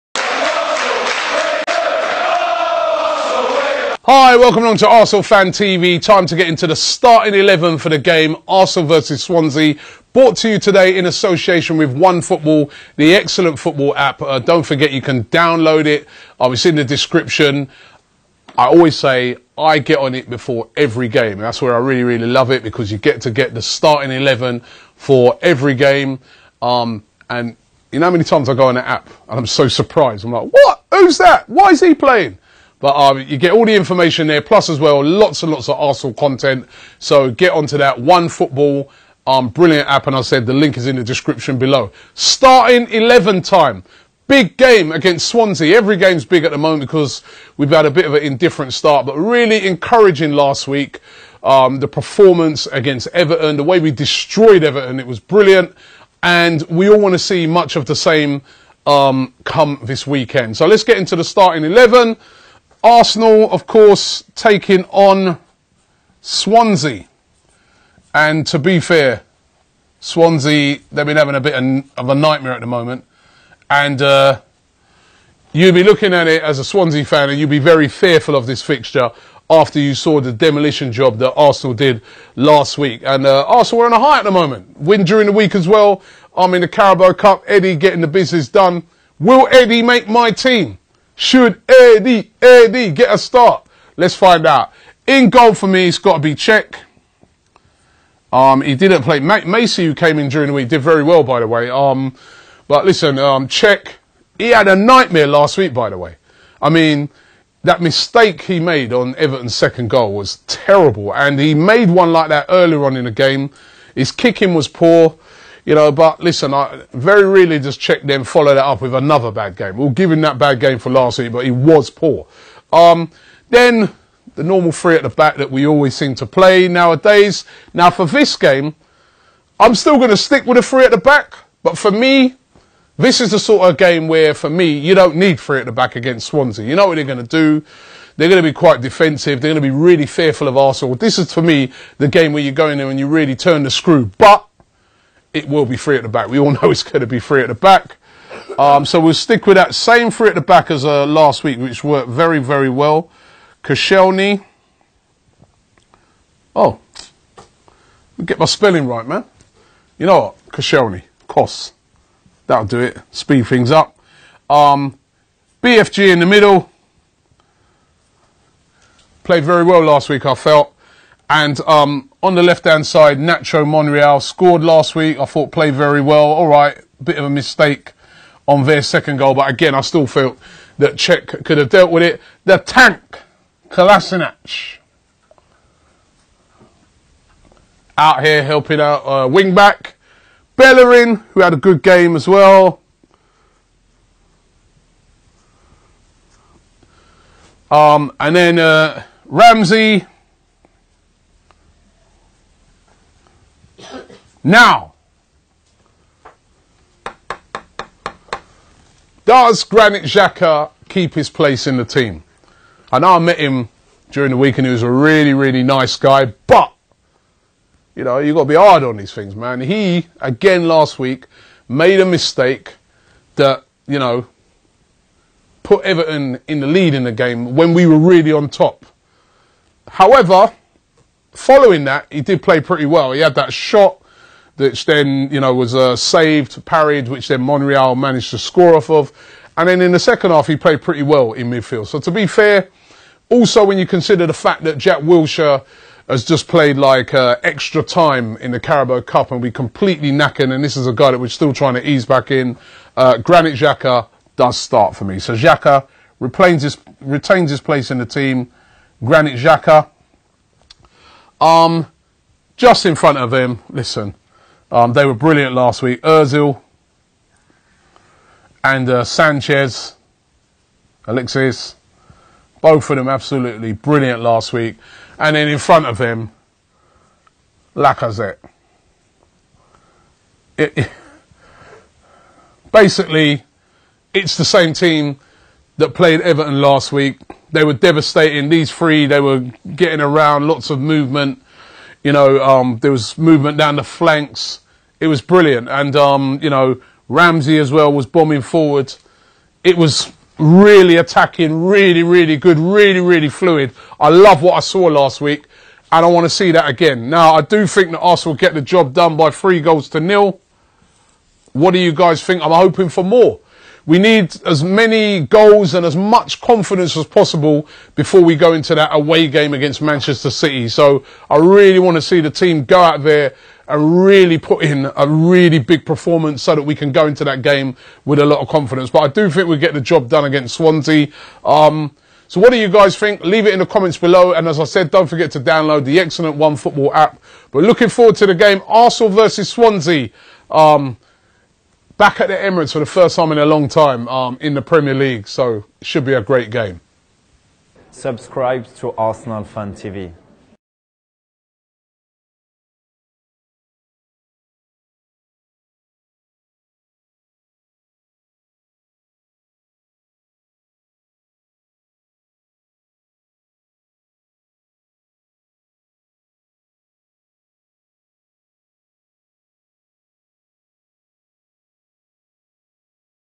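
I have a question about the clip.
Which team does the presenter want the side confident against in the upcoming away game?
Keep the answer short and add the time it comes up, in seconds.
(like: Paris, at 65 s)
Manchester City, at 319 s.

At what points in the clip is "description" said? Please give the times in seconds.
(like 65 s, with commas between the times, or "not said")
16 s, 41 s.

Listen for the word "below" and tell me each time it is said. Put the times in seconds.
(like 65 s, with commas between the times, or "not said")
41 s, 333 s.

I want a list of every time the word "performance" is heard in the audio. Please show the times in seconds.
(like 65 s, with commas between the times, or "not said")
51 s, 325 s.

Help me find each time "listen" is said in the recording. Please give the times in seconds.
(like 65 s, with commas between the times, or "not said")
102 s, 116 s, 263 s.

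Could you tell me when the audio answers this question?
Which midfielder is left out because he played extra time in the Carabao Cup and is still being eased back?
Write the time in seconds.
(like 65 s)
244 s.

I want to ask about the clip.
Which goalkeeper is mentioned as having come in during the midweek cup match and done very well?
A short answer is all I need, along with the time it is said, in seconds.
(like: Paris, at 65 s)
Macey, at 99 s.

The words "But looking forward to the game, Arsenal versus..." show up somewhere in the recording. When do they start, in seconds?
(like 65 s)
337 s.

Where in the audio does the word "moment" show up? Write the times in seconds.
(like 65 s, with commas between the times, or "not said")
46 s, 72 s, 84 s.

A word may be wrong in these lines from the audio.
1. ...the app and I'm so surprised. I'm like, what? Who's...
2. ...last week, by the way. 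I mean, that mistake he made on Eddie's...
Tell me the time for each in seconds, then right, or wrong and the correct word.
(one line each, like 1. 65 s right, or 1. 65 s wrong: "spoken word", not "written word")
1. 28 s right
2. 105 s wrong: "Everton", not "Eddie".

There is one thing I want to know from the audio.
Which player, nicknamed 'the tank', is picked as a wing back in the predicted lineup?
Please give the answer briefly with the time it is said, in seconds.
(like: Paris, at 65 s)
Kolasinac, at 183 s.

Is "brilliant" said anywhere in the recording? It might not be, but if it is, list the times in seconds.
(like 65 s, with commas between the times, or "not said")
39 s, 55 s, 265 s, 273 s, 295 s.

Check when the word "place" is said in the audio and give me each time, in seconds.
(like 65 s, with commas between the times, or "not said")
211 s, 257 s.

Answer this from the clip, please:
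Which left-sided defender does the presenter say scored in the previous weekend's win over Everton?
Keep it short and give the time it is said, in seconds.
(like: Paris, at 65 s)
Nacho Monreal, at 173 s.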